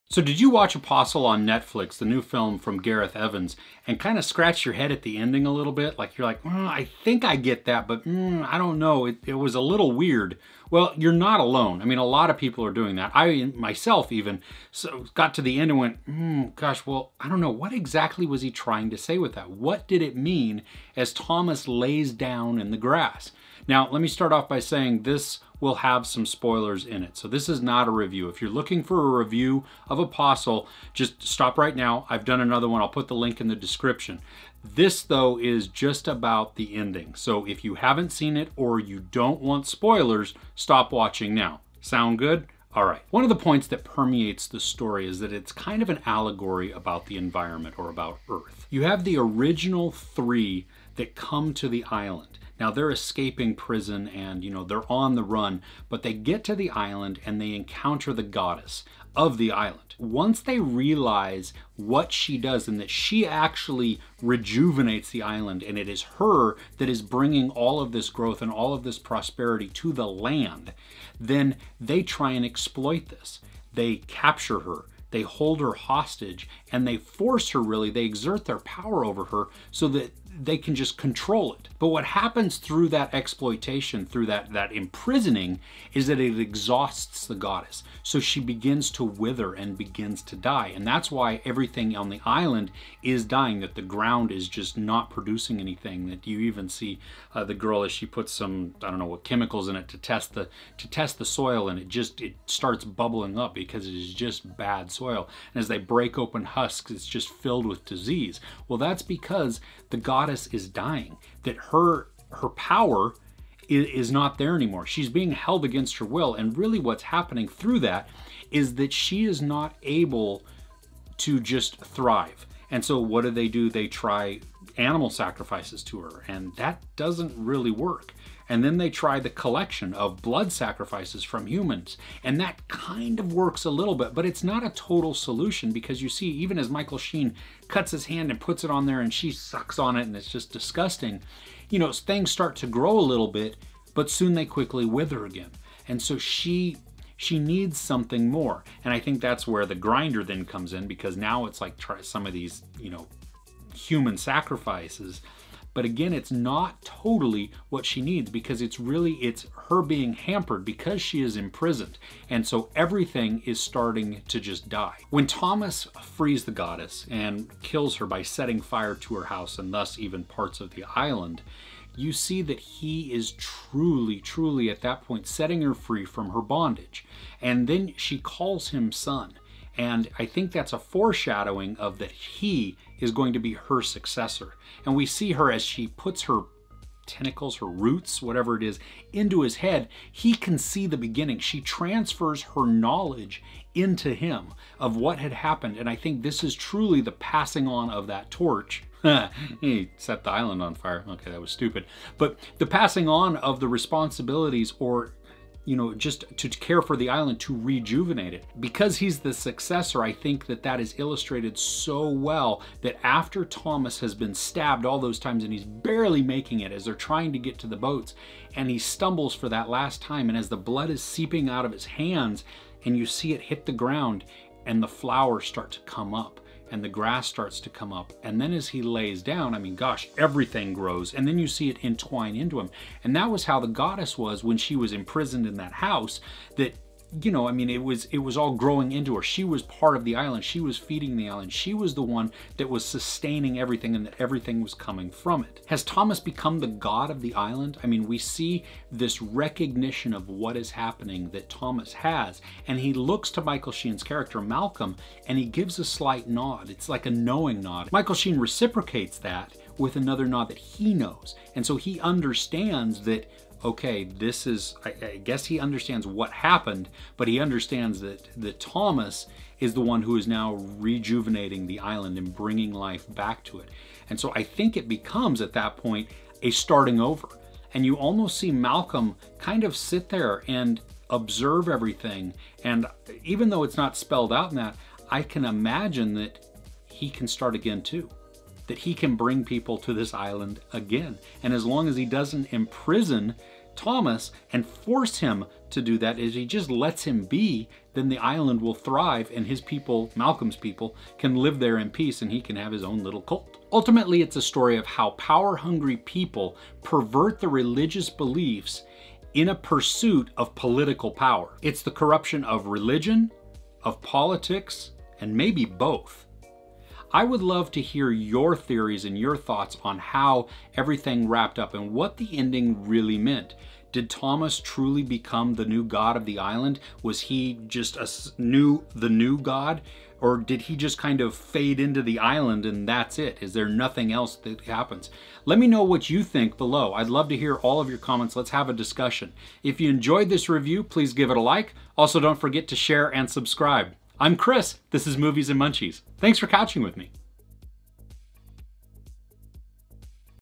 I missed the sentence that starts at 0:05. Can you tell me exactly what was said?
Like, you're like, mm, I think I get that, but mm, I don't know.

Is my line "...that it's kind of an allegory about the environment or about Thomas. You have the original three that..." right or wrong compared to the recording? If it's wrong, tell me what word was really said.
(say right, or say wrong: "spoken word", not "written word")
wrong: "Earth", not "Thomas".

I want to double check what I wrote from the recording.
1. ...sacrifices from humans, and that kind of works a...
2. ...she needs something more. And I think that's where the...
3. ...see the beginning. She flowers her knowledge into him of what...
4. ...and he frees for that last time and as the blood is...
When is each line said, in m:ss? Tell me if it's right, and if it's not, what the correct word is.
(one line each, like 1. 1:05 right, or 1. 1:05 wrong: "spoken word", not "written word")
1. 2:10 right
2. 2:27 right
3. 3:10 wrong: "transfers", not "flowers"
4. 3:38 wrong: "stumbles", not "frees".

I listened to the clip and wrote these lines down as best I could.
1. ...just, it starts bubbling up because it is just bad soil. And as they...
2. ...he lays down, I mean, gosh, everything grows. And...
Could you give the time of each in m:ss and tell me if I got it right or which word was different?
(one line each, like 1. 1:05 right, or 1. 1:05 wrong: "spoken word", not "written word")
1. 1:41 right
2. 3:48 right.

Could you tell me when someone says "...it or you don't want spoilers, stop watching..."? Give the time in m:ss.
0:38.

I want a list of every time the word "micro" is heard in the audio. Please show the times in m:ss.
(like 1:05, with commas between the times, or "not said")
not said.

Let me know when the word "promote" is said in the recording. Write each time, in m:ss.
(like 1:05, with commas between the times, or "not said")
not said.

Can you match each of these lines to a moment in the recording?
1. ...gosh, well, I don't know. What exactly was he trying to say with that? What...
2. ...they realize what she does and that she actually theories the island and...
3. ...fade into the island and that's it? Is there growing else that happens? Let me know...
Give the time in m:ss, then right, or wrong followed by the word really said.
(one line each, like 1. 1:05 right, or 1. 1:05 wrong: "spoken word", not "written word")
1. 0:16 right
2. 1:00 wrong: "rejuvenates", not "theories"
3. 5:31 wrong: "nothing", not "growing".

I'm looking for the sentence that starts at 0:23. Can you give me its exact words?
Now, let me start off by saying this will have some spoilers in it.